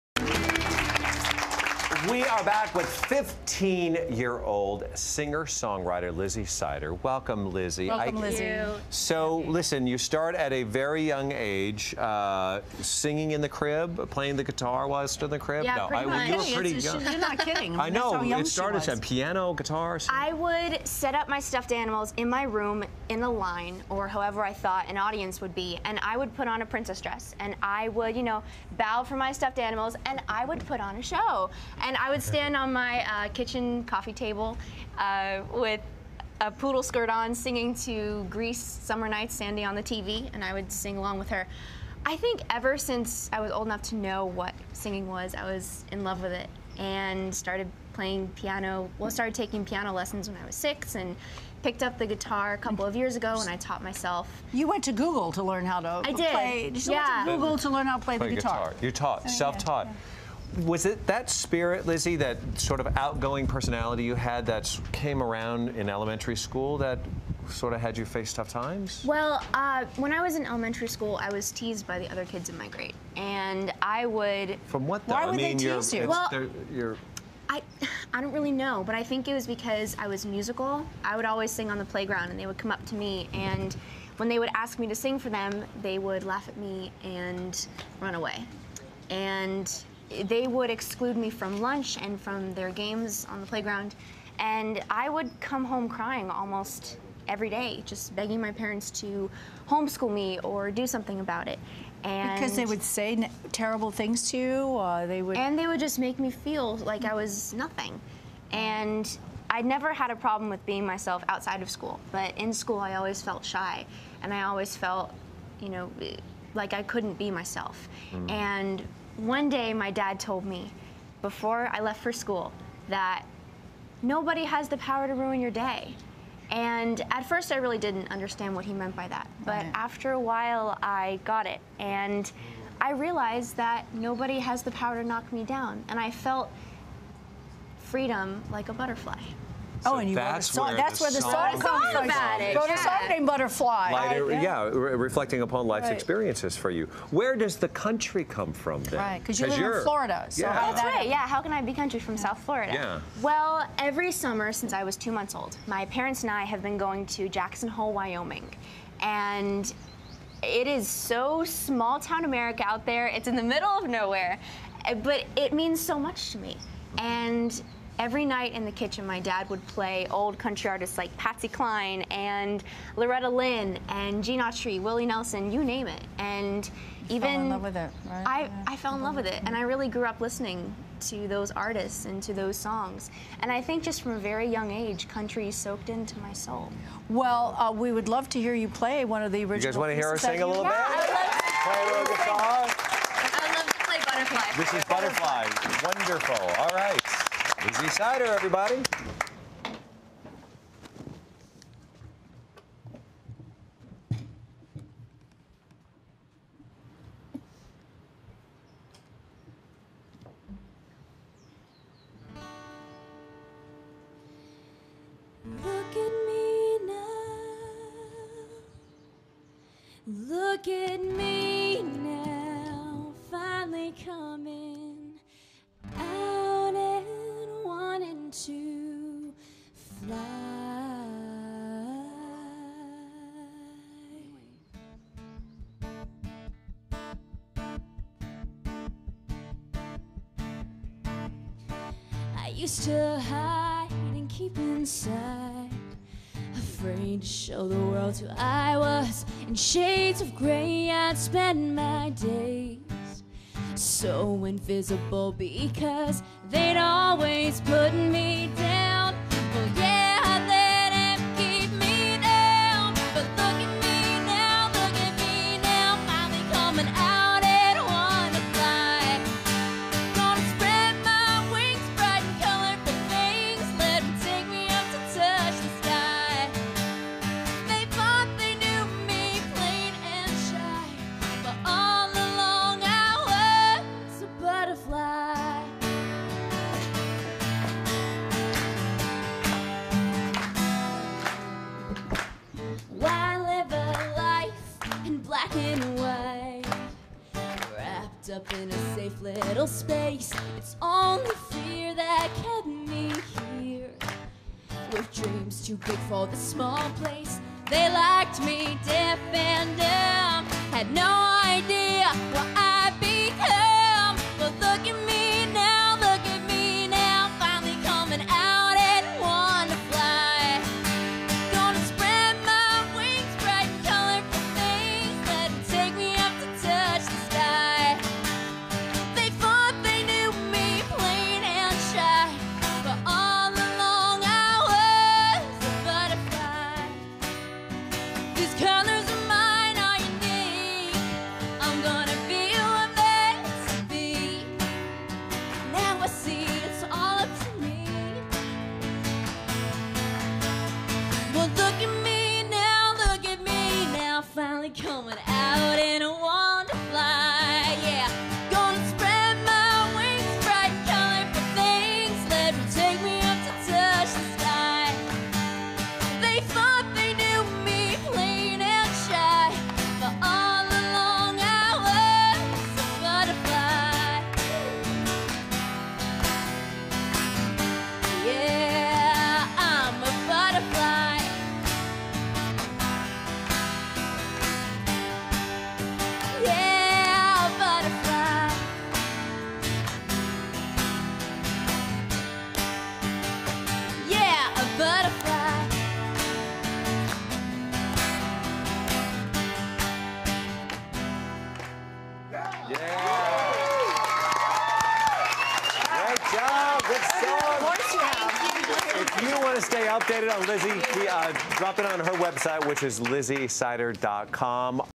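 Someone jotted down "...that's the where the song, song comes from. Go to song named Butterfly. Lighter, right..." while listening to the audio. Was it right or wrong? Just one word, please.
right.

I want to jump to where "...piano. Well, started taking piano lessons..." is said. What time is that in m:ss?
0:48.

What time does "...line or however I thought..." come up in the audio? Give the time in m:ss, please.
0:23.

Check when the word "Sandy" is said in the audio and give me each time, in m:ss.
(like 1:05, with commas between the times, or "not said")
0:39.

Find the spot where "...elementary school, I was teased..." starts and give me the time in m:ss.
1:10.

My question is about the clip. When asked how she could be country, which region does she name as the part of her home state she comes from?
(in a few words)
South Florida.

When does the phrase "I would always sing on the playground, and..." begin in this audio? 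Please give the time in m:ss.
1:21.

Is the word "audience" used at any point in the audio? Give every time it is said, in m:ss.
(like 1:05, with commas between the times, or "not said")
0:24.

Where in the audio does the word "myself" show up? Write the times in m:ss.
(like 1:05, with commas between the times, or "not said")
0:53, 1:50, 1:57.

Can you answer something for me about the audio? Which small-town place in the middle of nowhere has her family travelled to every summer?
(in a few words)
Jackson Hole, Wyoming.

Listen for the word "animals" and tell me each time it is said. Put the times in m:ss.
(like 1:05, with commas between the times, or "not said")
0:21, 0:29.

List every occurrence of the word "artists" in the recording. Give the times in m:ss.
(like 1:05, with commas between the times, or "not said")
2:50, 3:01.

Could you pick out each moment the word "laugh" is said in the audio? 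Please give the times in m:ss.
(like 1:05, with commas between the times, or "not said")
1:26.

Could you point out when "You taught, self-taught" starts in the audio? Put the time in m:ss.
0:58.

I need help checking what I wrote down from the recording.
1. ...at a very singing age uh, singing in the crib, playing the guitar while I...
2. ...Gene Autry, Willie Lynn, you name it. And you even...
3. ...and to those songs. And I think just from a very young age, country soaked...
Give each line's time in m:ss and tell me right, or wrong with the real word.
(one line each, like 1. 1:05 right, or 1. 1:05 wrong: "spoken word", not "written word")
1. 0:10 wrong: "young", not "singing"
2. 2:54 wrong: "Nelson", not "Lynn"
3. 3:02 right.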